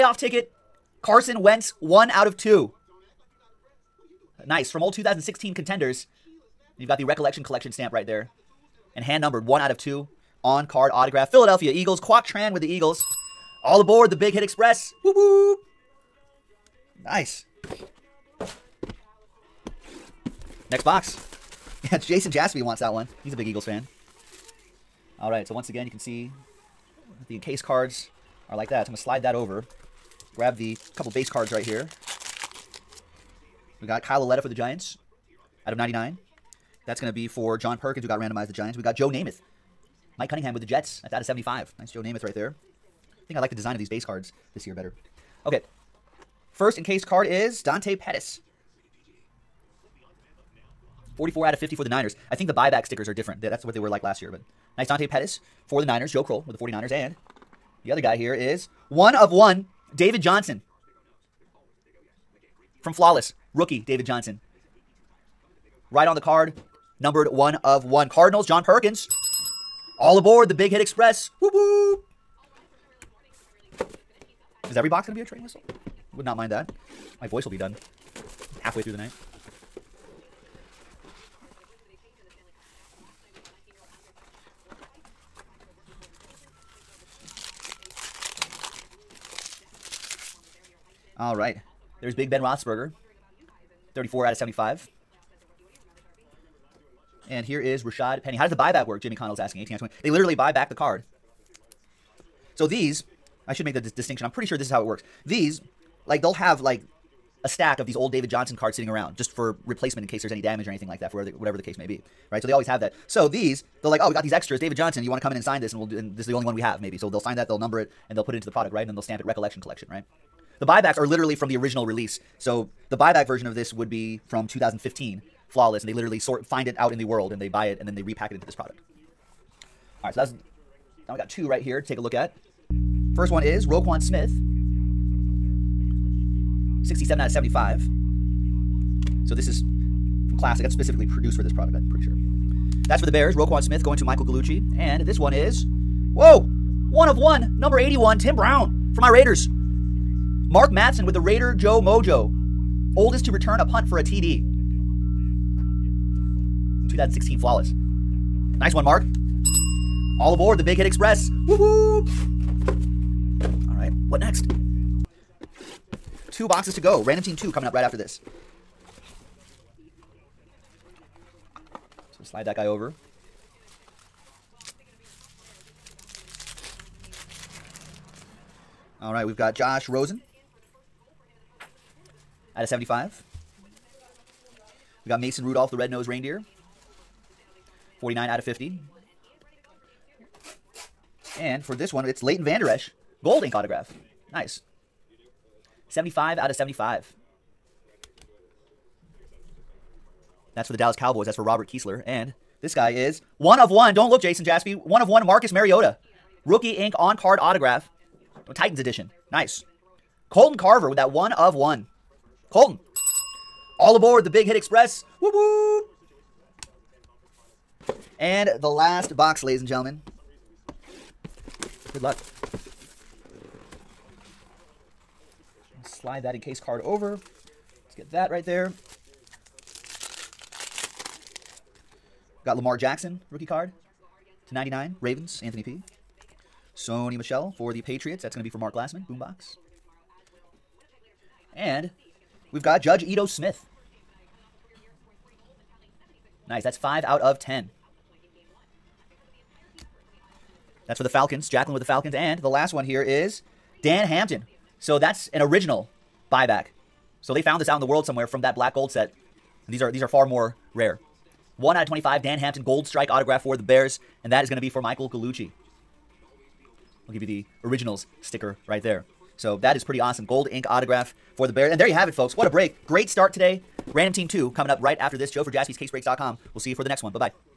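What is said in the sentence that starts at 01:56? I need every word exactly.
So they'll sign that, they'll number it, and they'll put it into the product, right?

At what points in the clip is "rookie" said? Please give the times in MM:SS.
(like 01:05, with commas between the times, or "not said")
01:03, 03:26, 03:53.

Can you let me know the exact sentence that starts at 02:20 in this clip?
That's specifically produced for this product, I'm pretty sure.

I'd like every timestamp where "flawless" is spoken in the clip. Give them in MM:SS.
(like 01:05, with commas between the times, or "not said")
01:02, 02:05, 02:37.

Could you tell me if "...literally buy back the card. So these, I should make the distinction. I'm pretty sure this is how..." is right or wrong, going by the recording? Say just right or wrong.
right.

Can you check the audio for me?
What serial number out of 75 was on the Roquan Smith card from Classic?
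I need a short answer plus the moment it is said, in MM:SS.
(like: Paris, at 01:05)
67, at 02:16.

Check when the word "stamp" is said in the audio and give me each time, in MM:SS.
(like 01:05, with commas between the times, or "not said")
00:07, 01:59.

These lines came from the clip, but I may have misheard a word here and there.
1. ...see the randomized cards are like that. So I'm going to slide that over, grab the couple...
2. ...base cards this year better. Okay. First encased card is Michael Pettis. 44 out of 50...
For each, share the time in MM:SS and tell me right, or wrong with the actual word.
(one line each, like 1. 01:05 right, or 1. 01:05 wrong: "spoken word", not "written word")
1. 00:25 wrong: "encased", not "randomized"
2. 00:43 wrong: "Dante", not "Michael".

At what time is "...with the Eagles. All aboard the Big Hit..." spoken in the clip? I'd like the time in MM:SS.
00:12.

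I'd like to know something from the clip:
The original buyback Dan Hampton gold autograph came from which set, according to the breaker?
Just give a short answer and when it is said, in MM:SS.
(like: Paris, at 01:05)
Black gold, at 04:18.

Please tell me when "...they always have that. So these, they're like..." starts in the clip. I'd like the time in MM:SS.
01:52.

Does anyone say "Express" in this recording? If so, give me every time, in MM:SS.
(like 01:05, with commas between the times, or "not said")
00:14, 01:10, 02:40, 03:34.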